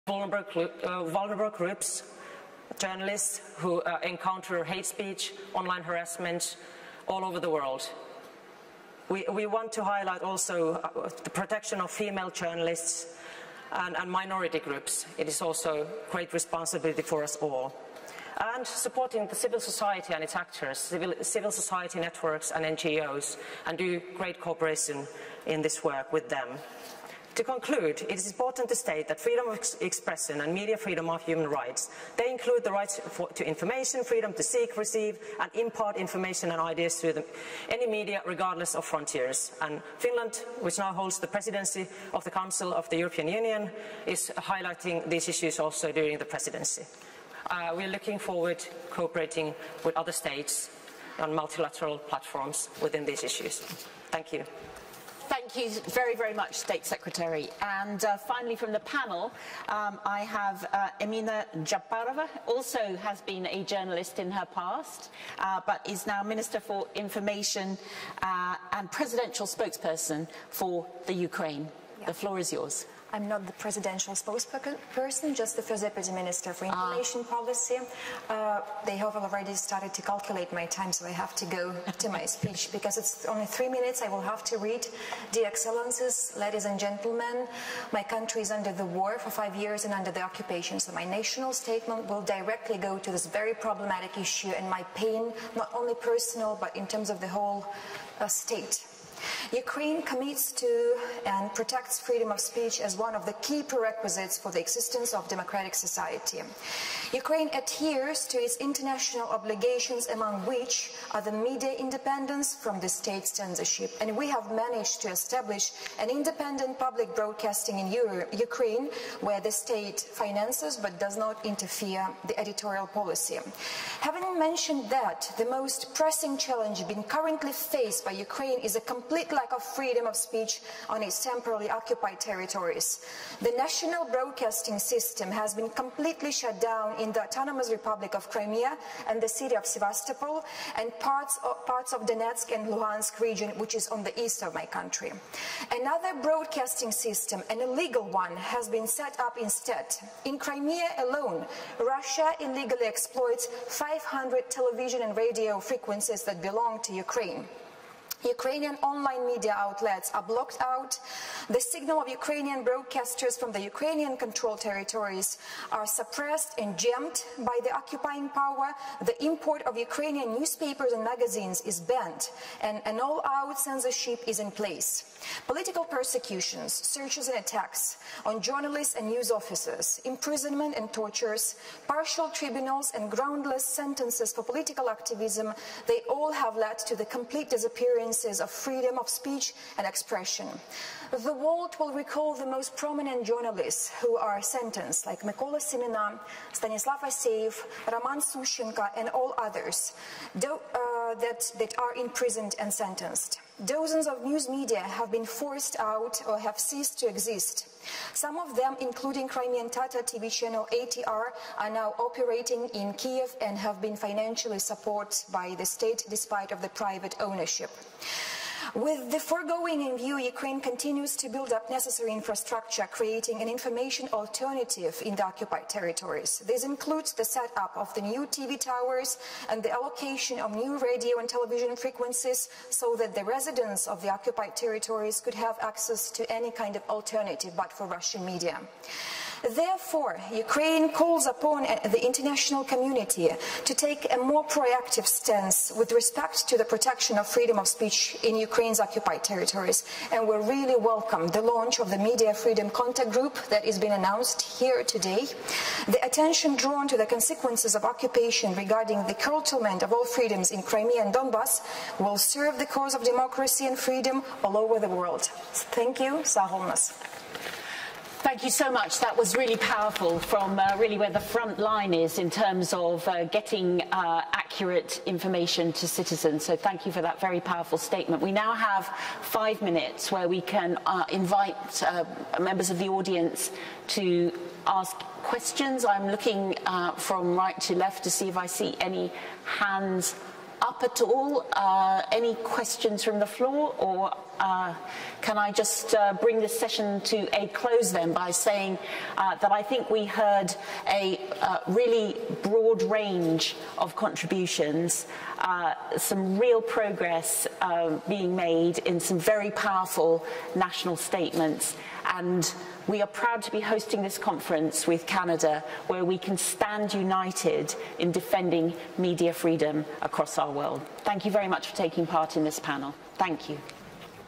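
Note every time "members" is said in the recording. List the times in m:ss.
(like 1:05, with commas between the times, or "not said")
4:42.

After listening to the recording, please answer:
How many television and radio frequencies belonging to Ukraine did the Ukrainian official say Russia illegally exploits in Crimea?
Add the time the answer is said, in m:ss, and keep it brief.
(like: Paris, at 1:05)
500, at 2:33.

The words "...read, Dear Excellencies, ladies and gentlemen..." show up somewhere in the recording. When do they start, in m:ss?
1:24.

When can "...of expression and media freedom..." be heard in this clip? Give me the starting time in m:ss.
0:29.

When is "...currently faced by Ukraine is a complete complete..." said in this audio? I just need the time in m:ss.
2:07.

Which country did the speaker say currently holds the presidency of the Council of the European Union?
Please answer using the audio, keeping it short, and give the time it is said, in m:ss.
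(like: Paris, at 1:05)
Finland, at 0:39.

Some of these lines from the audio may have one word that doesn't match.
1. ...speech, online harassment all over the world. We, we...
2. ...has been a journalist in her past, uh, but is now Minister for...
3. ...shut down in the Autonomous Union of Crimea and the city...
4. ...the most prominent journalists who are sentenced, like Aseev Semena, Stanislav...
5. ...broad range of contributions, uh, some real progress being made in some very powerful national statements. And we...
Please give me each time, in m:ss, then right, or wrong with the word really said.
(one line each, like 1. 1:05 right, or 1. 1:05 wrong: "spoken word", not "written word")
1. 0:04 right
2. 1:02 right
3. 2:16 wrong: "Republic", not "Union"
4. 3:12 wrong: "Mykola", not "Aseev"
5. 5:02 right.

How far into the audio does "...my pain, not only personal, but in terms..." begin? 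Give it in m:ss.
1:34.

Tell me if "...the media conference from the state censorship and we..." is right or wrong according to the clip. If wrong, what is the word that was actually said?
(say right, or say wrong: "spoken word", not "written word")
wrong: "independence", not "conference".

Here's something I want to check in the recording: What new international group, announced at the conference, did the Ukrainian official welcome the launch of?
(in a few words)
Media Freedom Contact Group.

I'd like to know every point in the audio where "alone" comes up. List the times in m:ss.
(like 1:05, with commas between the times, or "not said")
2:30.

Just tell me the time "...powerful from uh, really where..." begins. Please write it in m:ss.
4:29.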